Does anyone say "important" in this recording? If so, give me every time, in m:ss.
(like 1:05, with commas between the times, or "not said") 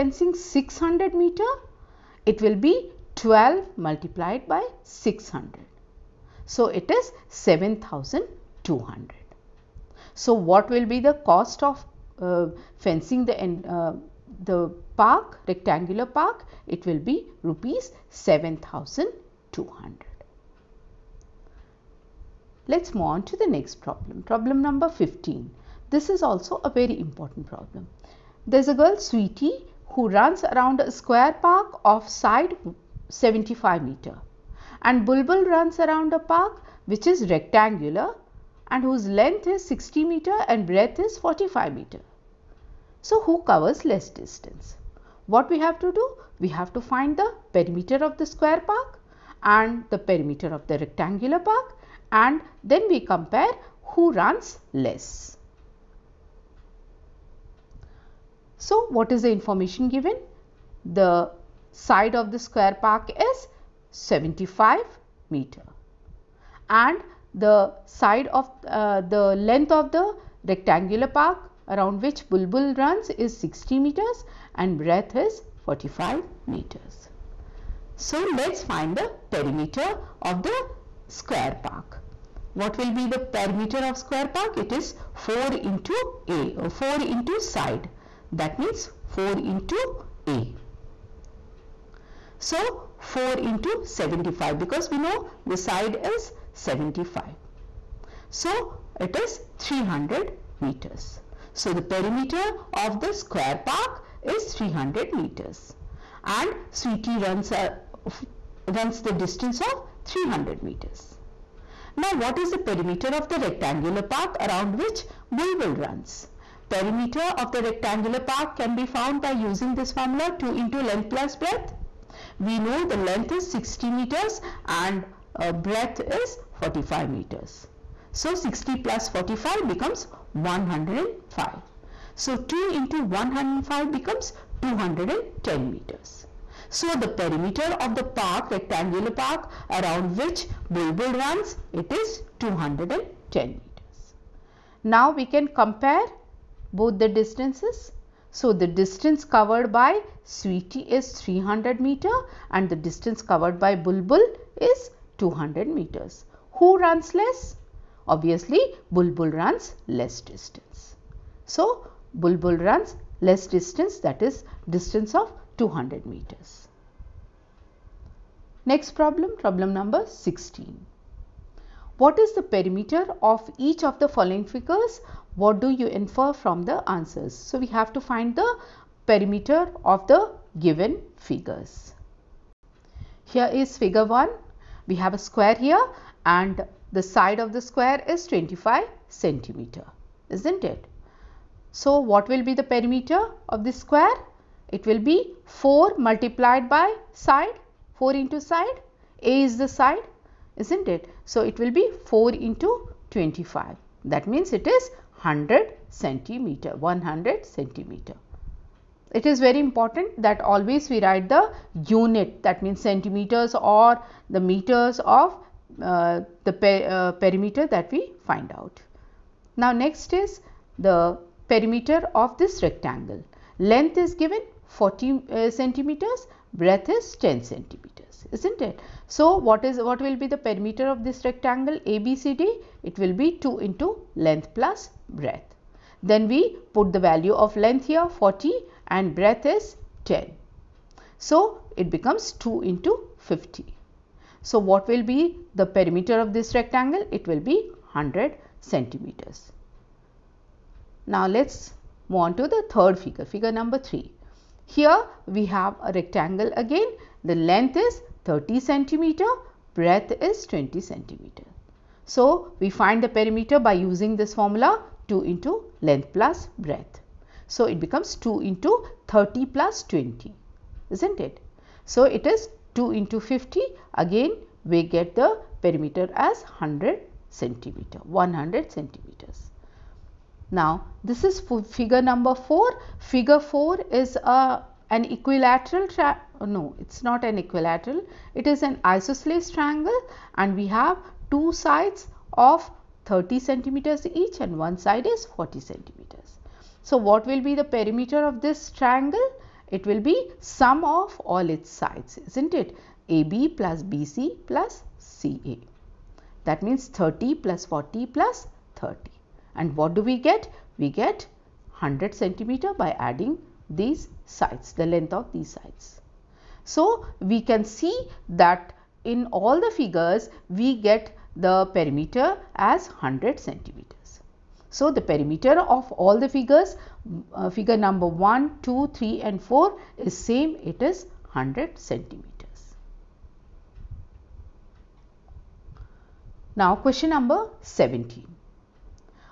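0:27, 3:29.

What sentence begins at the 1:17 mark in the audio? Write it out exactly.
So, let us find the perimeter of the square park.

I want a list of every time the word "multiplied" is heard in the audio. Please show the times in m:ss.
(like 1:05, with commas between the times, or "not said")
0:03, 3:15.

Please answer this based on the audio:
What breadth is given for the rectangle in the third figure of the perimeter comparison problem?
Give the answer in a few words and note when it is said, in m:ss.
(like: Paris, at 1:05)
20 centimeters, at 4:19.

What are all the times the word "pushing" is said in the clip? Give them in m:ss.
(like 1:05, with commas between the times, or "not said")
not said.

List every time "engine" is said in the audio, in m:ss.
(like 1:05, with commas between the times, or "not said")
not said.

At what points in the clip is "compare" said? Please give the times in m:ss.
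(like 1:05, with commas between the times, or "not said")
0:52, 2:25.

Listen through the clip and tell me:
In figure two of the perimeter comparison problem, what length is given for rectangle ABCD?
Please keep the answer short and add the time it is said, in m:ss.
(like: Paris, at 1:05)
40 centimeters, at 3:43.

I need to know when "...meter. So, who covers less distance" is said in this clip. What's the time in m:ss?
0:41.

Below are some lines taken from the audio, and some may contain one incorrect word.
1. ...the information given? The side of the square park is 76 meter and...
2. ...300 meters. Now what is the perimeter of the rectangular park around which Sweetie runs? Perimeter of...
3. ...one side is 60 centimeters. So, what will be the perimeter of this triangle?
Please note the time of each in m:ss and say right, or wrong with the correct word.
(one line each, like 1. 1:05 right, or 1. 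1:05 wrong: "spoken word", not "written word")
1. 0:59 wrong: "75", not "76"
2. 1:50 wrong: "Bulbul", not "Sweetie"
3. 4:54 wrong: "40", not "60".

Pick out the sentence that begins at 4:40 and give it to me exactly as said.
Now, this is figure number 4.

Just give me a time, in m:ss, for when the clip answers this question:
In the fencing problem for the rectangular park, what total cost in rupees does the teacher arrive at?
0:06.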